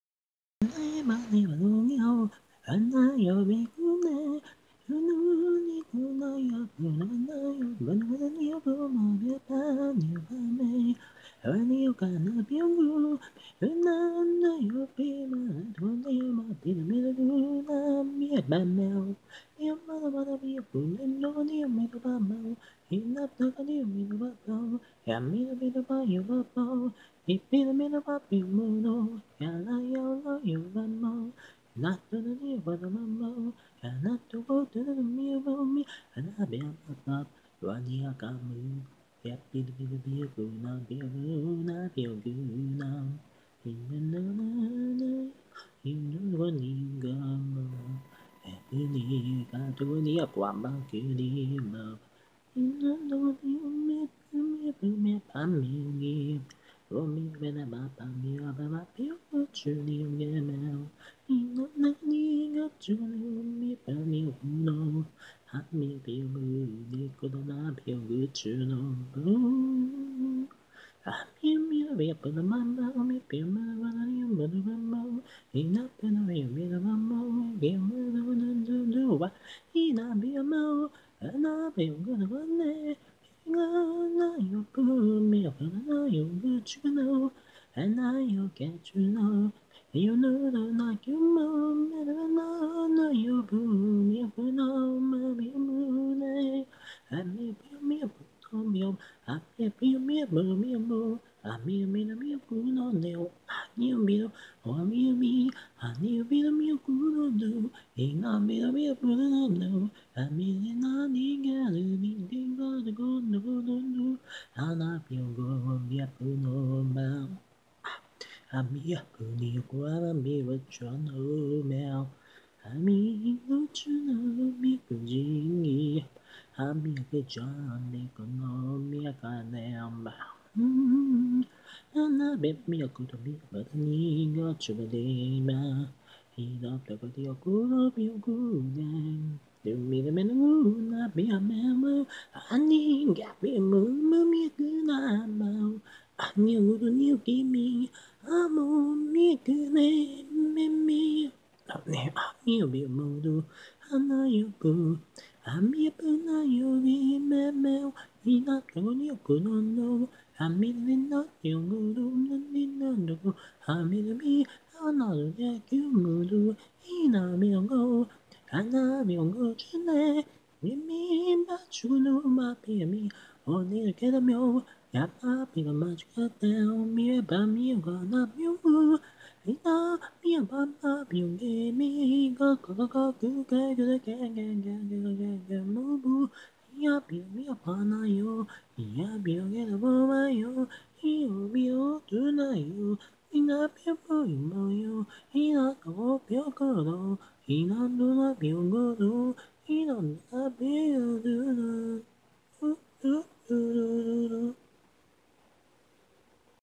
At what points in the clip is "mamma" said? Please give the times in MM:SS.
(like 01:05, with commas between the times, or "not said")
00:32.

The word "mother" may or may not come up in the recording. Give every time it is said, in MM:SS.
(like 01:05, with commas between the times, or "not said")
00:19.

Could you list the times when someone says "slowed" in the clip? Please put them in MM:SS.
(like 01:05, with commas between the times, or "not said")
not said.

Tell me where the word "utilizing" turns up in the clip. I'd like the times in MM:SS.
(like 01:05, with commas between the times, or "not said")
not said.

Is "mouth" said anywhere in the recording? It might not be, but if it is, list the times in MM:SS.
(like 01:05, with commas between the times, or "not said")
00:22.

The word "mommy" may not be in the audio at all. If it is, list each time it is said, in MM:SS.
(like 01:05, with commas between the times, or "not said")
01:34.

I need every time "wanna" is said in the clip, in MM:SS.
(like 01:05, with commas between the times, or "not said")
00:20.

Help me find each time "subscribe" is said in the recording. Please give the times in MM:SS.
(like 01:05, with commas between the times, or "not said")
00:54.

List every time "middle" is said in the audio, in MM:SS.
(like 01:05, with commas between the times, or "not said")
00:16, 00:27.